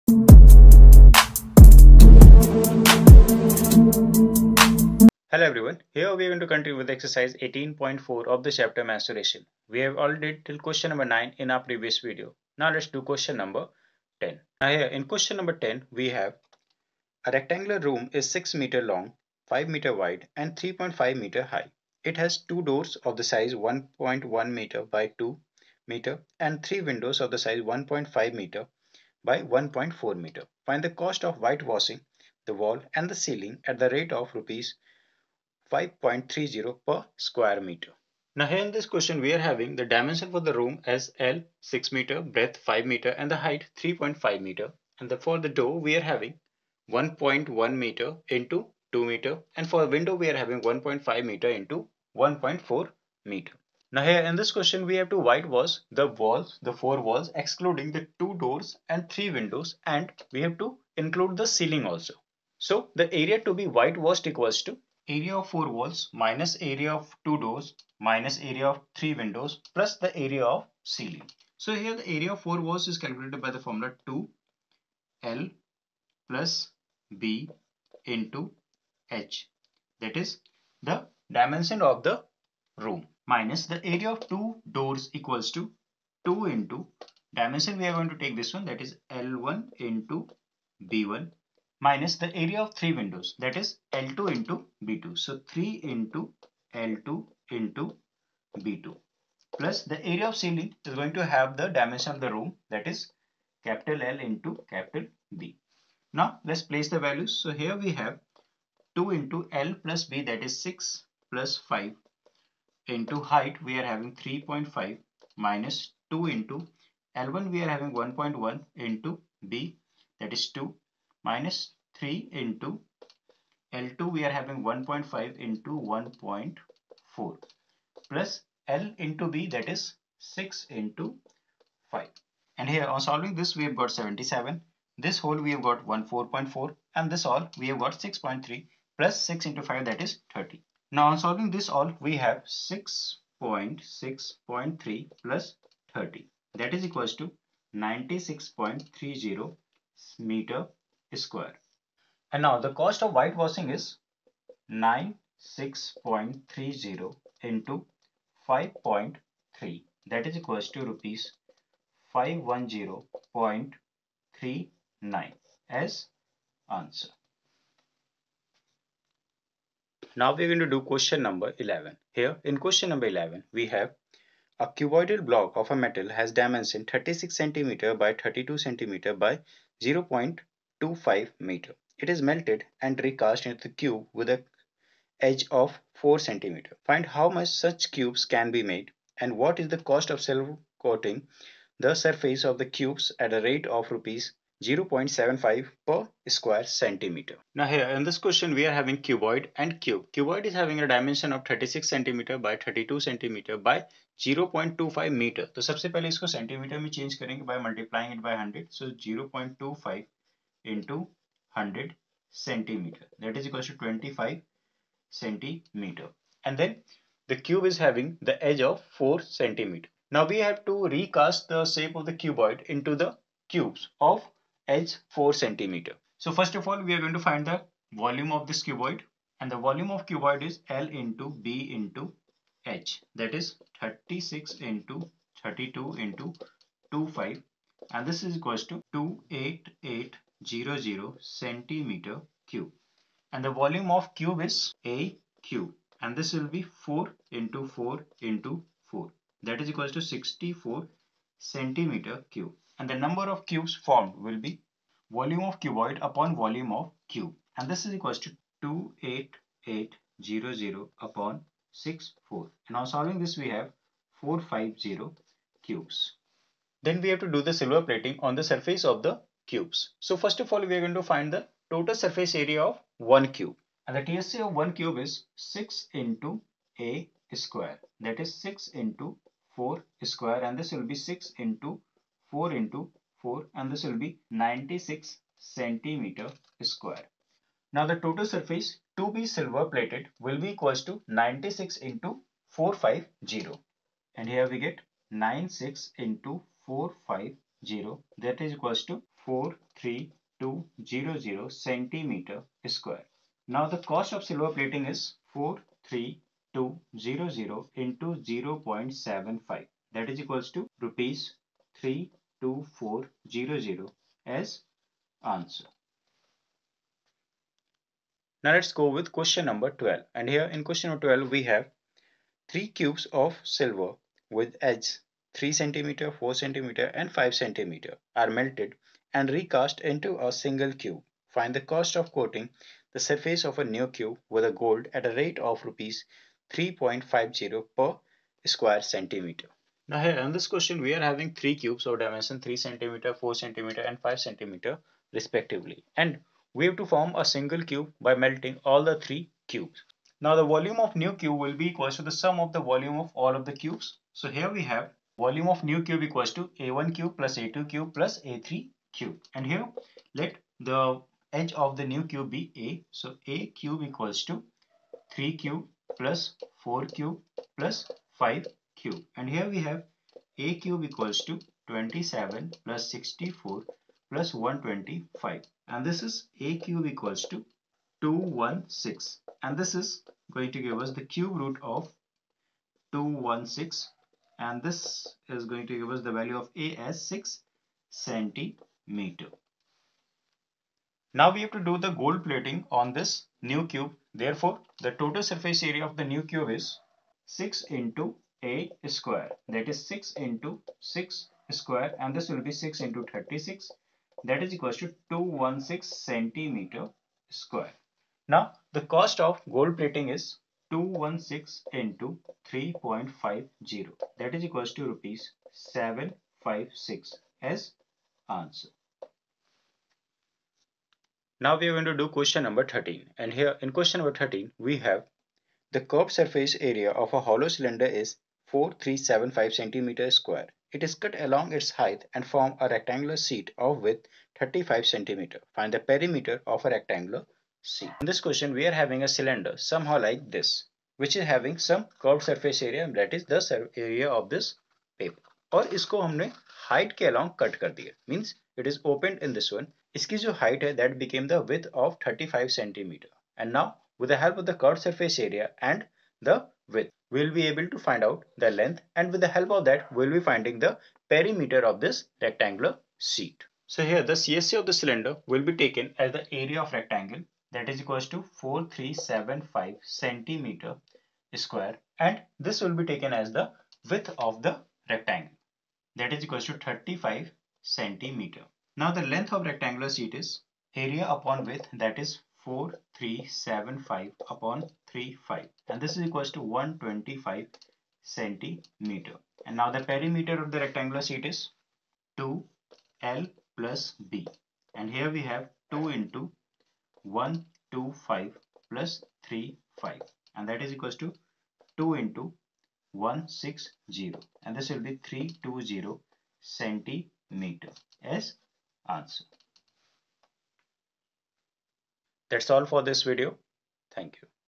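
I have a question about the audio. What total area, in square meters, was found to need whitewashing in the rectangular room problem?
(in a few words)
96.30.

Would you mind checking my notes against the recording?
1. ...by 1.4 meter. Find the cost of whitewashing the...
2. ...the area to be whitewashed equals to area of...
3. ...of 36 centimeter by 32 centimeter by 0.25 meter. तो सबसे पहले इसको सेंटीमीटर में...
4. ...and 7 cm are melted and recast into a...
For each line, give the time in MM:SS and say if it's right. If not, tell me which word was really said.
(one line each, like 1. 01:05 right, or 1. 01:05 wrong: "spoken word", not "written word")
1. 00:29 right
2. 01:02 right
3. 03:21 right
4. 05:26 wrong: "5", not "7".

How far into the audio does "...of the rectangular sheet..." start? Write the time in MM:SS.
08:10.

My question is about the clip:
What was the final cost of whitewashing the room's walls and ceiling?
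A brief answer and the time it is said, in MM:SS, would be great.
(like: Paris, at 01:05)
Rs 510.39, at 02:40.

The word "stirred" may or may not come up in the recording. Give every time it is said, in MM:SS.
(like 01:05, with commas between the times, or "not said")
not said.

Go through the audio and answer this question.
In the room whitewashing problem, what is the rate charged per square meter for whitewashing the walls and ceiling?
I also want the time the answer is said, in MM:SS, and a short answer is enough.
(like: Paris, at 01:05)
Rs 5.30, at 00:35.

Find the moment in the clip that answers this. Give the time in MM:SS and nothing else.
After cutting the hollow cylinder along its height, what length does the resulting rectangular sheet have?
08:06.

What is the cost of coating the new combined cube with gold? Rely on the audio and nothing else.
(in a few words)
Rs 756.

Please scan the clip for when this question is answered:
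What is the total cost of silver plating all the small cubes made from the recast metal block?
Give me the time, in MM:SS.
05:10.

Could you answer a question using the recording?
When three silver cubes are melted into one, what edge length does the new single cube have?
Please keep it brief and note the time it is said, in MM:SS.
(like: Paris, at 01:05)
6 cm, at 06:27.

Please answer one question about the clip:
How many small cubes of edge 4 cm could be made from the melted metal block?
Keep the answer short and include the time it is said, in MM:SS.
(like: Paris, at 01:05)
450, at 04:24.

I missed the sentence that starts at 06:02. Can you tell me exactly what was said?
So a cube equals to 3 cube plus 4 cube plus 5 cube.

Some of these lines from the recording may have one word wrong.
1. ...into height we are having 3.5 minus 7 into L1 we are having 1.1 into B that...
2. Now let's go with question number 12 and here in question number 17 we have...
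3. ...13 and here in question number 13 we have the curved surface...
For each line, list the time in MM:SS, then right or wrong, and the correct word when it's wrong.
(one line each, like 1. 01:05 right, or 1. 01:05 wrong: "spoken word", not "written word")
1. 01:52 wrong: "2", not "7"
2. 05:18 wrong: "12", not "17"
3. 07:02 right.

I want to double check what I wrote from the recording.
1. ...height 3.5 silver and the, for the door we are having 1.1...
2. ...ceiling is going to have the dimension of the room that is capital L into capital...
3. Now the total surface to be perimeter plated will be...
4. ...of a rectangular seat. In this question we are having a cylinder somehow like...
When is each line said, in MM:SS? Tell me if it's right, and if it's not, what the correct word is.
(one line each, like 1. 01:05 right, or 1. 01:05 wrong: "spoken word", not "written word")
1. 00:43 wrong: "meter", not "silver"
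2. 01:40 right
3. 04:47 wrong: "silver", not "perimeter"
4. 07:16 right.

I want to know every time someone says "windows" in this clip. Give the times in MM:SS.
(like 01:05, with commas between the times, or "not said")
00:26, 00:49, 00:59, 01:09, 01:32.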